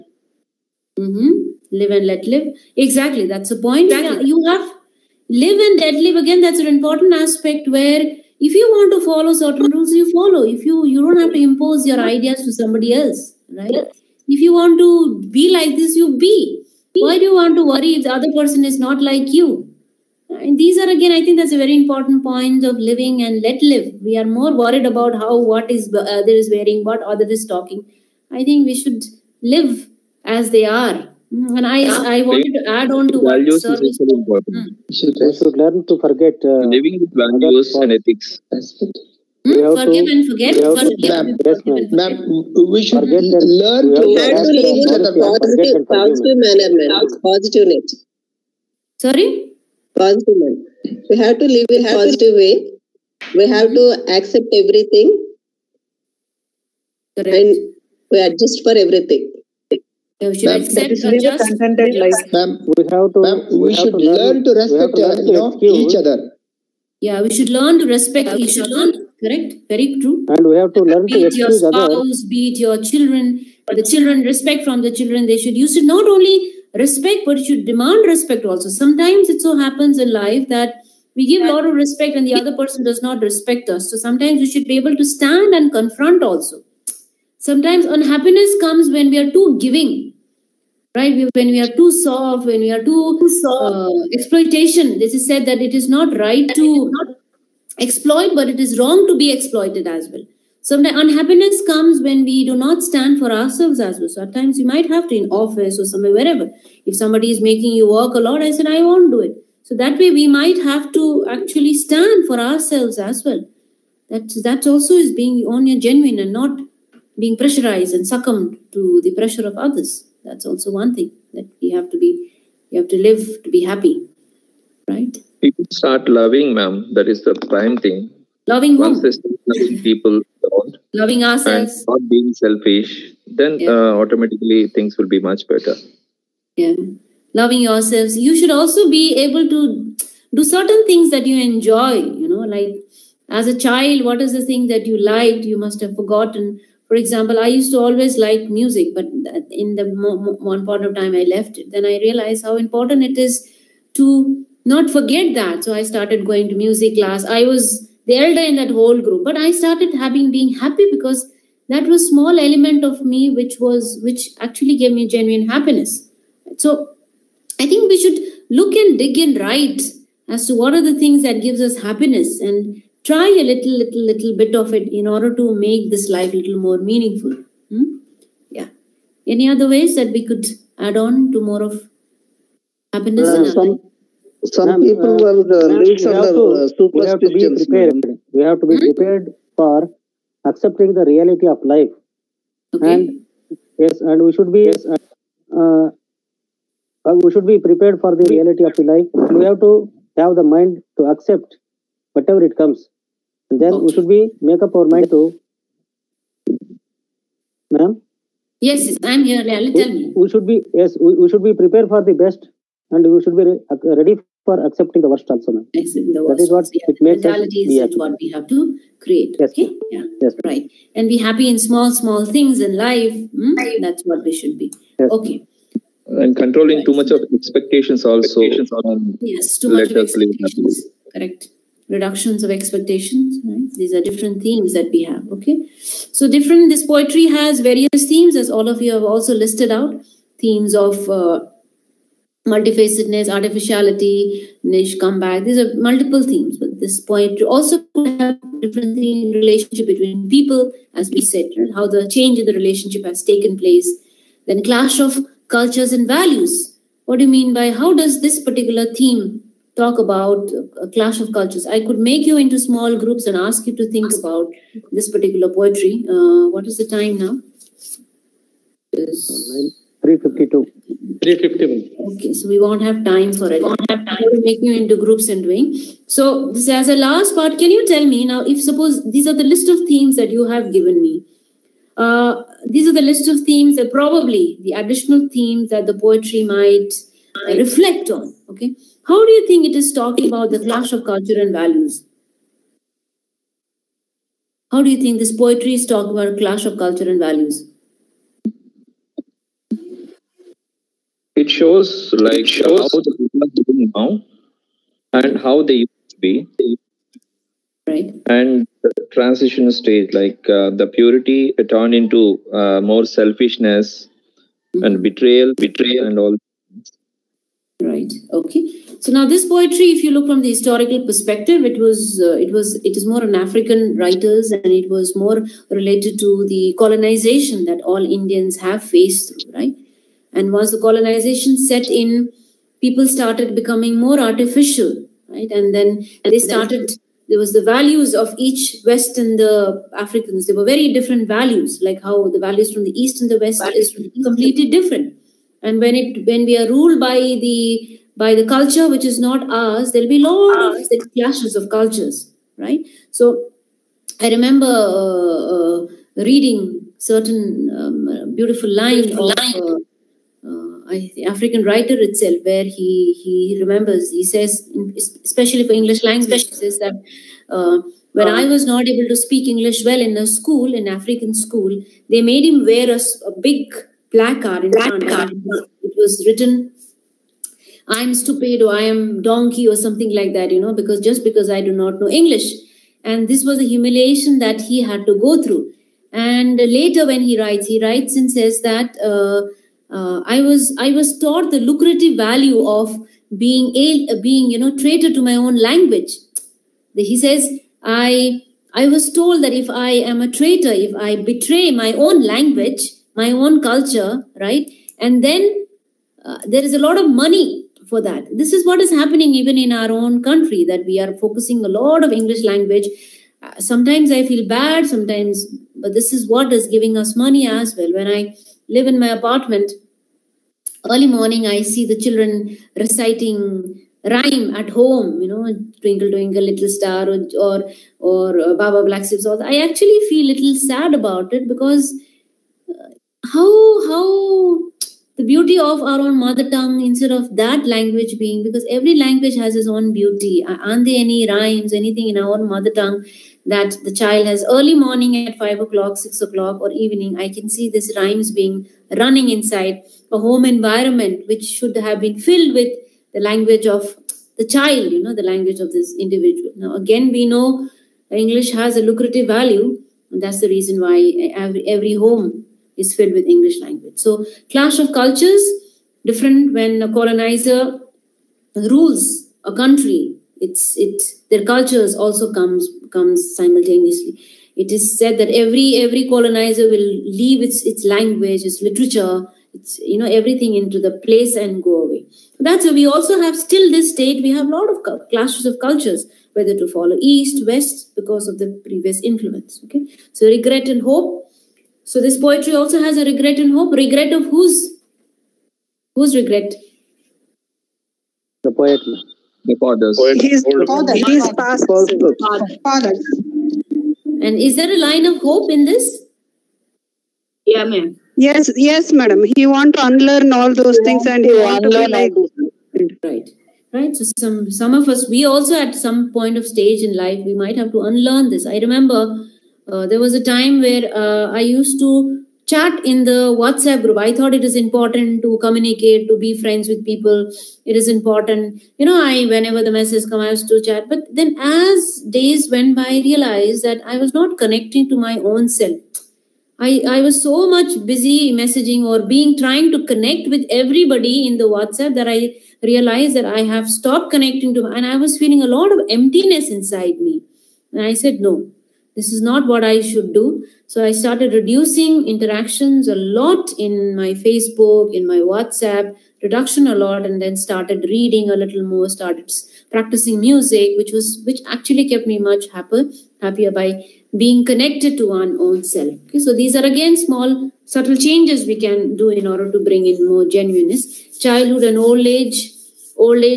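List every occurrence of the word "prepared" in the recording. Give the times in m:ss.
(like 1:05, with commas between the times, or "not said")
3:08, 3:17, 3:31.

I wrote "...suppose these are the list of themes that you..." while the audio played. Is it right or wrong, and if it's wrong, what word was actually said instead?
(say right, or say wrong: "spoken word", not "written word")
right.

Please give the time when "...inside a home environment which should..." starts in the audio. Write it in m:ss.
7:29.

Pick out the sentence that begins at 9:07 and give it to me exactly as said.
And I said, no, this is not what I should do.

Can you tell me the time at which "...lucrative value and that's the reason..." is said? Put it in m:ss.
7:38.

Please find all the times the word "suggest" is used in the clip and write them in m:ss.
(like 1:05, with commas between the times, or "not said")
not said.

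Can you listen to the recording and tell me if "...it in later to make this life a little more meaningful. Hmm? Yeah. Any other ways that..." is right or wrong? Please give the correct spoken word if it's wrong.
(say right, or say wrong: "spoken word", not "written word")
wrong: "order", not "later".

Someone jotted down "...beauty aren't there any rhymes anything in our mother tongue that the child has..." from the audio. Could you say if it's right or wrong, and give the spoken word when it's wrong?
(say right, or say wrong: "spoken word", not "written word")
right.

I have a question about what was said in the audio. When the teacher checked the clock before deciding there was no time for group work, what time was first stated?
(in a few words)
352.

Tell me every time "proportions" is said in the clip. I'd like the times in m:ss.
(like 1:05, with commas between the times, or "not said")
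not said.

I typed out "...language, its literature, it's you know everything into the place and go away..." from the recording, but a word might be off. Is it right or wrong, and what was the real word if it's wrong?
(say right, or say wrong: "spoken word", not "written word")
right.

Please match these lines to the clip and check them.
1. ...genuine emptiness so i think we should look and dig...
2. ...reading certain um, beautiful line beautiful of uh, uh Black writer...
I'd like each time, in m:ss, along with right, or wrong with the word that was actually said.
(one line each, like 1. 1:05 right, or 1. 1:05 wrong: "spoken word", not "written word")
1. 2:45 wrong: "happiness", not "emptiness"
2. 5:56 wrong: "African", not "Black".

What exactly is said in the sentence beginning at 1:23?
So sometimes we should be able to stand and confront also.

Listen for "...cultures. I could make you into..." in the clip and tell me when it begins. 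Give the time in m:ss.
4:21.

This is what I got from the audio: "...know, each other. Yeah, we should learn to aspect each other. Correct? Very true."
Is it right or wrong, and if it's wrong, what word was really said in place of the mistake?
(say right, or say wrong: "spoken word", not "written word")
wrong: "respect", not "aspect".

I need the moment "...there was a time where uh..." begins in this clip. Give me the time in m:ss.
8:39.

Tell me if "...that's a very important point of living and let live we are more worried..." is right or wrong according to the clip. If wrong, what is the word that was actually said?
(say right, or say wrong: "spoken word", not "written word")
right.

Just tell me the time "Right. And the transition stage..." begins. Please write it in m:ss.
5:07.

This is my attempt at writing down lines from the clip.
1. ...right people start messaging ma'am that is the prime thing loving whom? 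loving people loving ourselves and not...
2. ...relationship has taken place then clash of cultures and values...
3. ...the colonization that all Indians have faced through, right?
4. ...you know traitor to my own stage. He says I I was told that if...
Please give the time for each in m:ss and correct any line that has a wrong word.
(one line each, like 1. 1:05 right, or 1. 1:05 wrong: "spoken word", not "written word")
1. 2:04 wrong: "loving", not "messaging"
2. 4:12 right
3. 5:26 right
4. 6:34 wrong: "language", not "stage".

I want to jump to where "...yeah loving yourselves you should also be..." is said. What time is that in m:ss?
2:16.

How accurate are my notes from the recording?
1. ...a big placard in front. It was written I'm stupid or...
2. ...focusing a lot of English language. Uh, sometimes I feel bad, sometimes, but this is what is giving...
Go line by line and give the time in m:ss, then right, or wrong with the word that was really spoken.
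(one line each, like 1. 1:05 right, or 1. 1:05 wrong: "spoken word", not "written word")
1. 6:12 right
2. 6:51 right.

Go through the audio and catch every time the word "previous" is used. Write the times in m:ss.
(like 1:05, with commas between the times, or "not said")
8:08.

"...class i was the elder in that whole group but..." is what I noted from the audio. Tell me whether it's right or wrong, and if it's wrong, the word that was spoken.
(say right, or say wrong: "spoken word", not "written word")
right.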